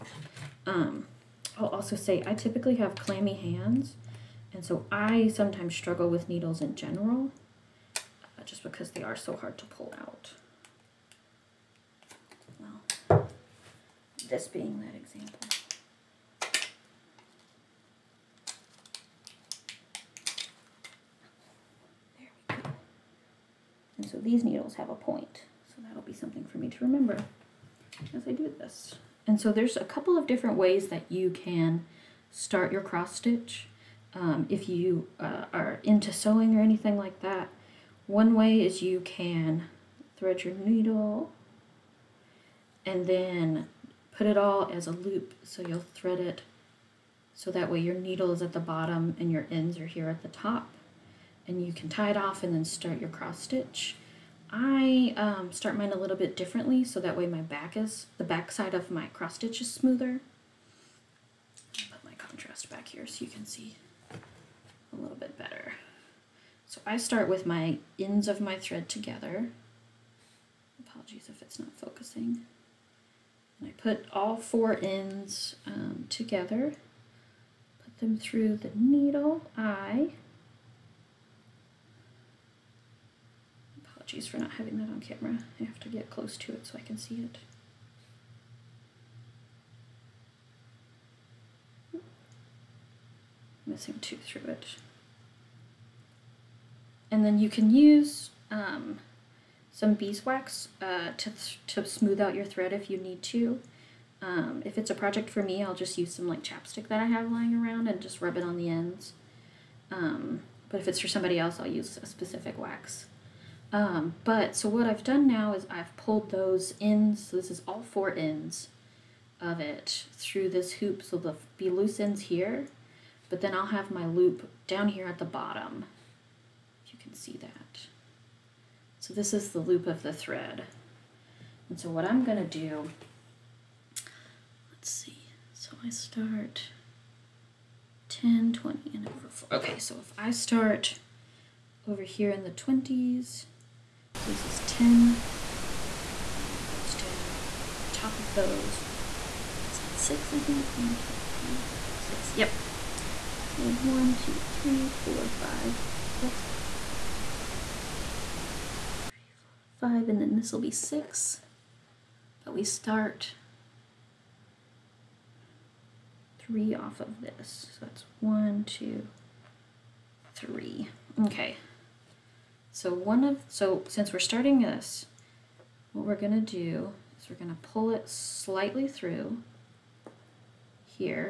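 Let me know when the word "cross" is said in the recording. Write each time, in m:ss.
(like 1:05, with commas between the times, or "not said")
0:32, 0:53, 0:59.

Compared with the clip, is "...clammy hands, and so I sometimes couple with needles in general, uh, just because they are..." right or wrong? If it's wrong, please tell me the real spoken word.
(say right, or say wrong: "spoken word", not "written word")
wrong: "struggle", not "couple".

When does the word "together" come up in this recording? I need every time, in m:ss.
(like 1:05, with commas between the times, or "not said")
1:08, 1:16.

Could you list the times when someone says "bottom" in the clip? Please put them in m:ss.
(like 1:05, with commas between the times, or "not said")
0:48, 2:05.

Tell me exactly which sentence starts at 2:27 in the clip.
The top of those is that 6, I think.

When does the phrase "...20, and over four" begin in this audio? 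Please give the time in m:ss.
2:18.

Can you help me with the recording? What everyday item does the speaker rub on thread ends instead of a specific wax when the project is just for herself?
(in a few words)
chapstick.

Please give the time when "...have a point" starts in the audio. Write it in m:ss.
0:24.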